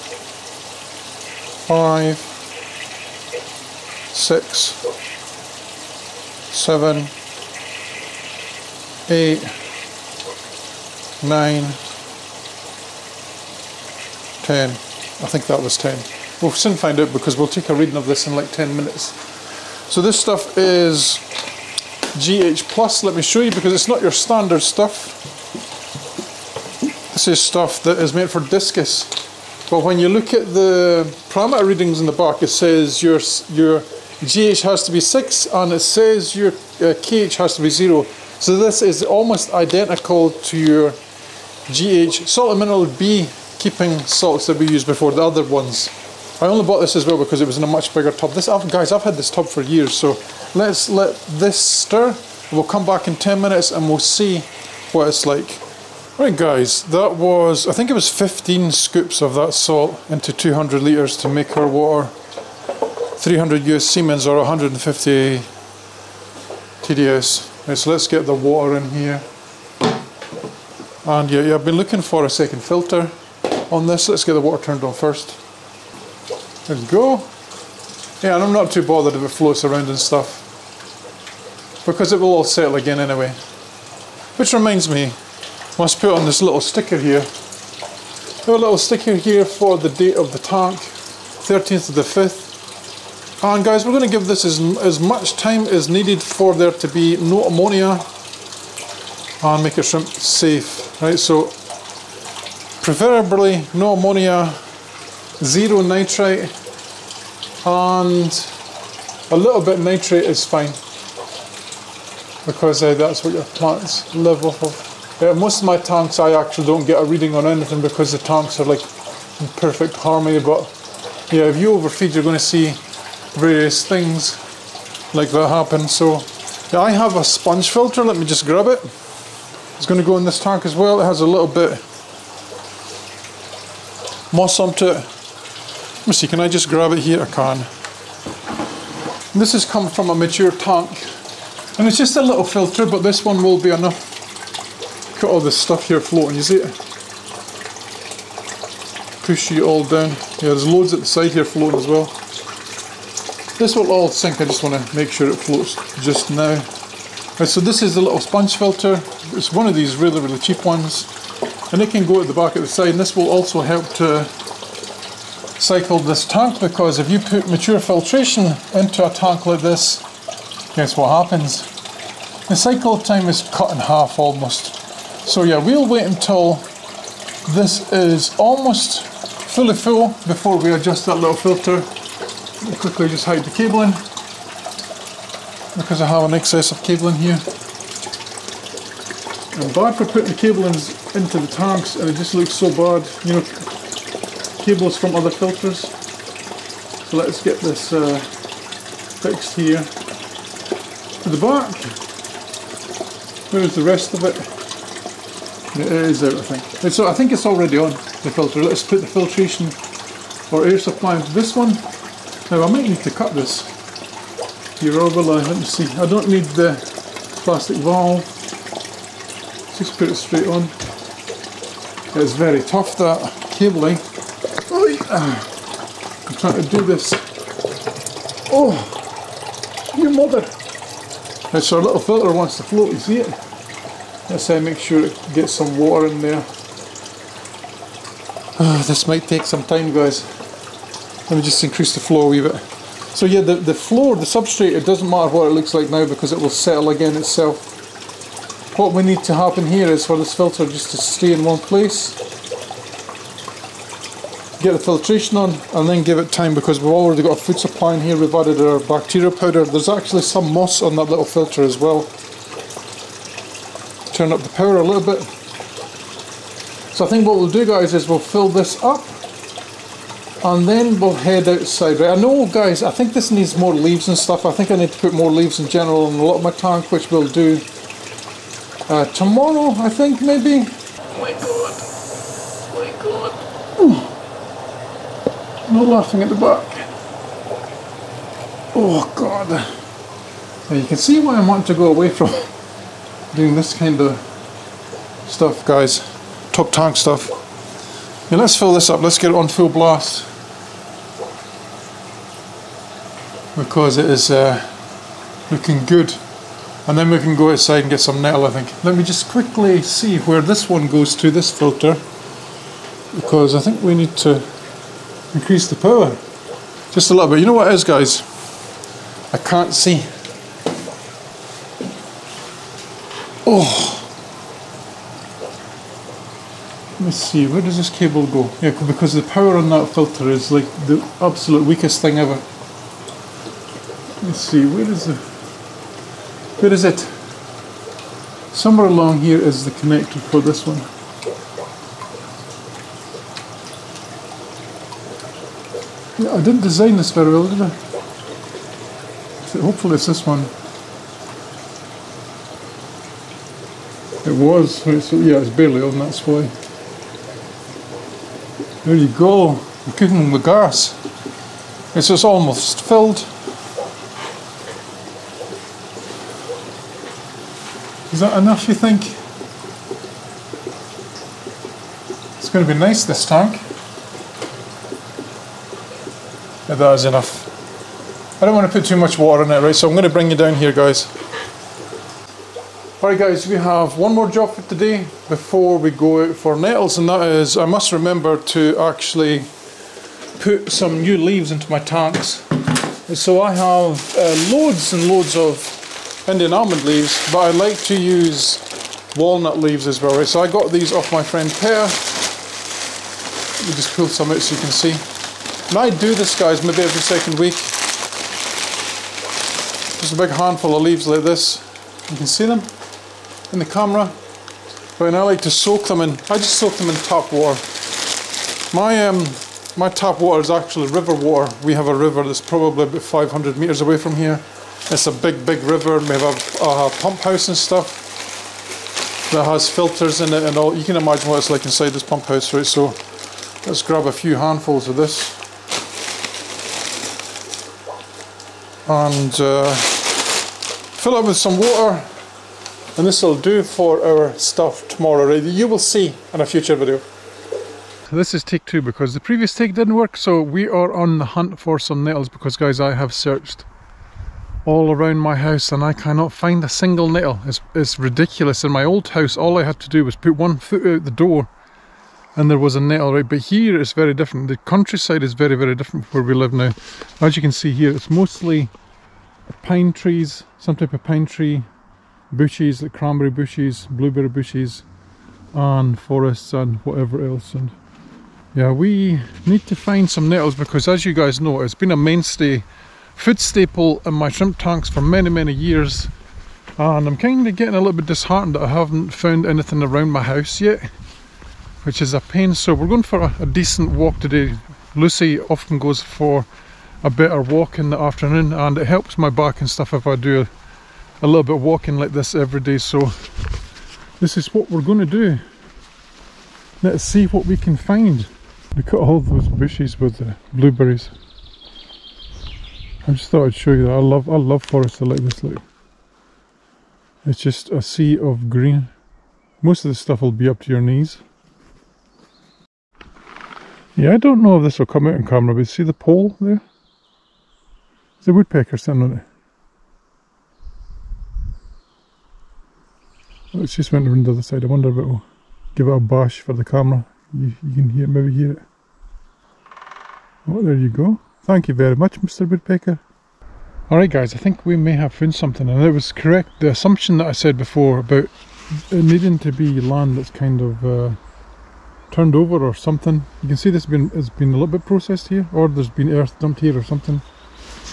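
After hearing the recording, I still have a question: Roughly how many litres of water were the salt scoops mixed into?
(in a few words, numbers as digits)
200 litres.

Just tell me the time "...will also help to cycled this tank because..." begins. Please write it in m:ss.
2:43.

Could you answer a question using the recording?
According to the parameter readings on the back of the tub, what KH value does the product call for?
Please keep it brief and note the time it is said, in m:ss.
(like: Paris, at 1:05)
0, at 0:37.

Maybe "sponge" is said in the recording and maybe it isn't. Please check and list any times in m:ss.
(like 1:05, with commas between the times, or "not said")
2:07, 2:38.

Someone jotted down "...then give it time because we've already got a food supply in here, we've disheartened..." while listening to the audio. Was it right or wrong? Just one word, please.
wrong.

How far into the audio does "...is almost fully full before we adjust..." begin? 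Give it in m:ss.
2:57.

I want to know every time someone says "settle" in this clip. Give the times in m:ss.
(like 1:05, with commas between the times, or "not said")
1:22, 4:06.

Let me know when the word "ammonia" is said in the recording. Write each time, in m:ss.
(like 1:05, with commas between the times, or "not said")
1:37, 1:43.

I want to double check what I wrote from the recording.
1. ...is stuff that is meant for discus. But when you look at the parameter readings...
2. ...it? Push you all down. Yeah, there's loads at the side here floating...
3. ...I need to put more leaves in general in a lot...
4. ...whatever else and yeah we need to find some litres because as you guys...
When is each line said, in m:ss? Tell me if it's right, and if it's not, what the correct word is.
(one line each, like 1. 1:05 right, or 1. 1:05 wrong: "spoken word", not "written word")
1. 0:27 right
2. 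2:26 right
3. 4:34 right
4. 7:56 wrong: "nettles", not "litres".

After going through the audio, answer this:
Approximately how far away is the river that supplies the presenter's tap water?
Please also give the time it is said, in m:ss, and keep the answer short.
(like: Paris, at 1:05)
500 meters, at 7:03.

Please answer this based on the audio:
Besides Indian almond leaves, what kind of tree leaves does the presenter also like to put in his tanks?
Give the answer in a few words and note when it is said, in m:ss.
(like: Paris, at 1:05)
Walnut leaves, at 6:39.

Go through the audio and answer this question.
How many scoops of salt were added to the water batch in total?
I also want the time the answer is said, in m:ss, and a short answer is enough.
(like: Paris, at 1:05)
15, at 0:58.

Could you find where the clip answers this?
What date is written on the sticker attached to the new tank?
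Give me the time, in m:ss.
1:30.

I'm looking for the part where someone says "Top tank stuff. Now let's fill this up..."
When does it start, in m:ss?
4:56.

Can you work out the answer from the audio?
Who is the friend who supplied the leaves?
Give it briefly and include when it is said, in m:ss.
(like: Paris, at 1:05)
Pear, at 6:41.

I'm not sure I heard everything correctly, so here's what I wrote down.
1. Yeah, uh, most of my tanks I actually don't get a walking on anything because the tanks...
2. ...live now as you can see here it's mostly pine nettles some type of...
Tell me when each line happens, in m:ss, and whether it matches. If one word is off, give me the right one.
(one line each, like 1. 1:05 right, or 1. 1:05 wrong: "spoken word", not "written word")
1. 1:55 wrong: "reading", not "walking"
2. 7:46 wrong: "trees", not "nettles".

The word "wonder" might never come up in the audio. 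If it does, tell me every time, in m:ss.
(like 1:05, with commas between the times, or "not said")
8:54.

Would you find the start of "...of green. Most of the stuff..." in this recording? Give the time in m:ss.
8:38.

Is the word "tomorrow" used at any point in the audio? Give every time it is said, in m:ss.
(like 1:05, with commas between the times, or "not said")
4:39, 7:24.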